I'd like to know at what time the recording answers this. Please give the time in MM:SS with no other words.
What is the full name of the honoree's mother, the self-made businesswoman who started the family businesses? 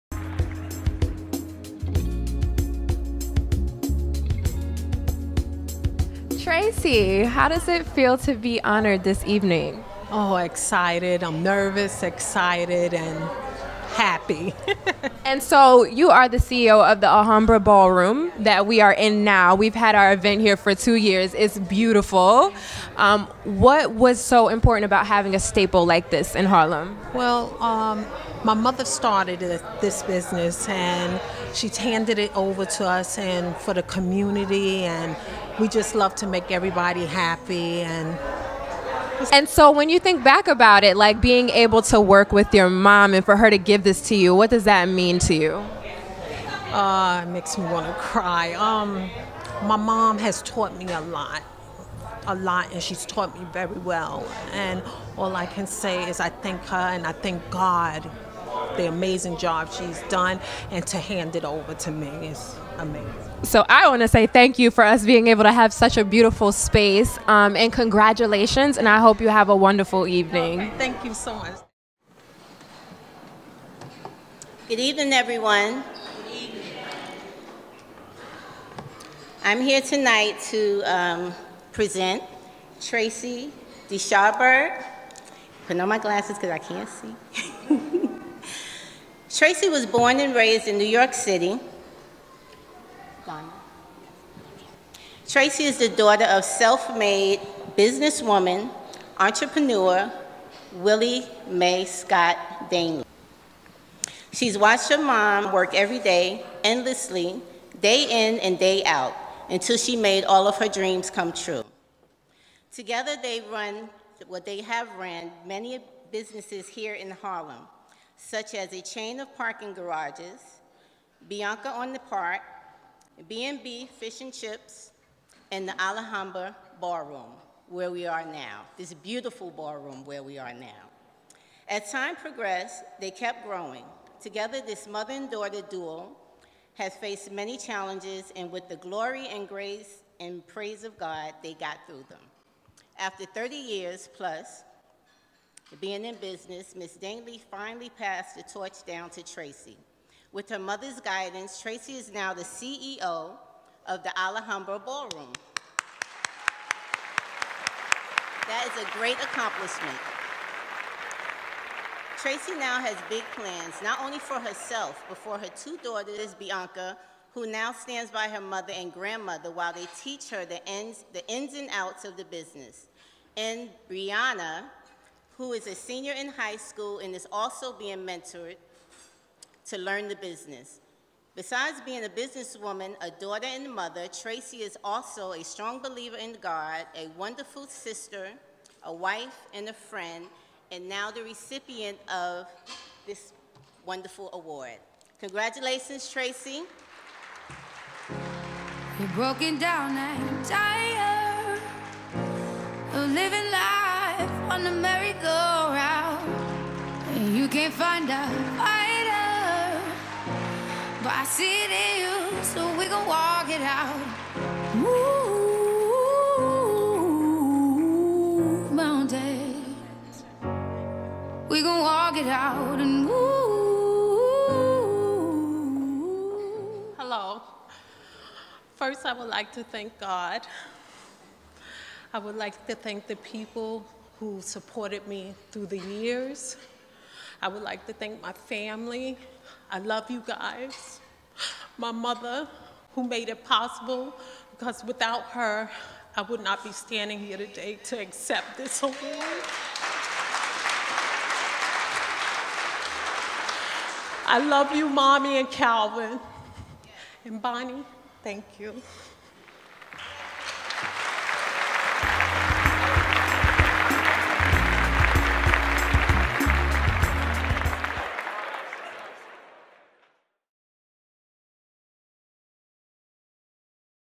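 01:40.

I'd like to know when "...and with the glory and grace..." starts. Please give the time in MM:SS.
02:18.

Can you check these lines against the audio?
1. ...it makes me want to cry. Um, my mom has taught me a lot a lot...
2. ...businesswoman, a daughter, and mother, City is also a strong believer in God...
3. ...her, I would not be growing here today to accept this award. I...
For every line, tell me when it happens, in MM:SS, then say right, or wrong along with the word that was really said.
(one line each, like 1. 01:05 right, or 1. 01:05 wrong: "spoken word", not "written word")
1. 00:47 right
2. 03:02 wrong: "Tracey", not "City"
3. 04:05 wrong: "standing", not "growing".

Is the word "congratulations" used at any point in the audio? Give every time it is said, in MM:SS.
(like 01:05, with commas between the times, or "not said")
01:07, 03:15.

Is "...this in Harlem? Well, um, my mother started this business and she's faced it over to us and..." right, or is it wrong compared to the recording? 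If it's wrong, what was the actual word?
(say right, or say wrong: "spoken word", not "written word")
wrong: "handed", not "faced".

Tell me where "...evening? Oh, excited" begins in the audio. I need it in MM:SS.
00:09.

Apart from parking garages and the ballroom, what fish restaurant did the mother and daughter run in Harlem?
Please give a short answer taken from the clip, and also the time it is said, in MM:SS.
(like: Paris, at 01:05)
B&B Fish and Chips, at 02:03.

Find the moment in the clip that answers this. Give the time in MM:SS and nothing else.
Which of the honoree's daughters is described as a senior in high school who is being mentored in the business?
02:53.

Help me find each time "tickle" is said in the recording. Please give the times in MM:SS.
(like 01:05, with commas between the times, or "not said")
not said.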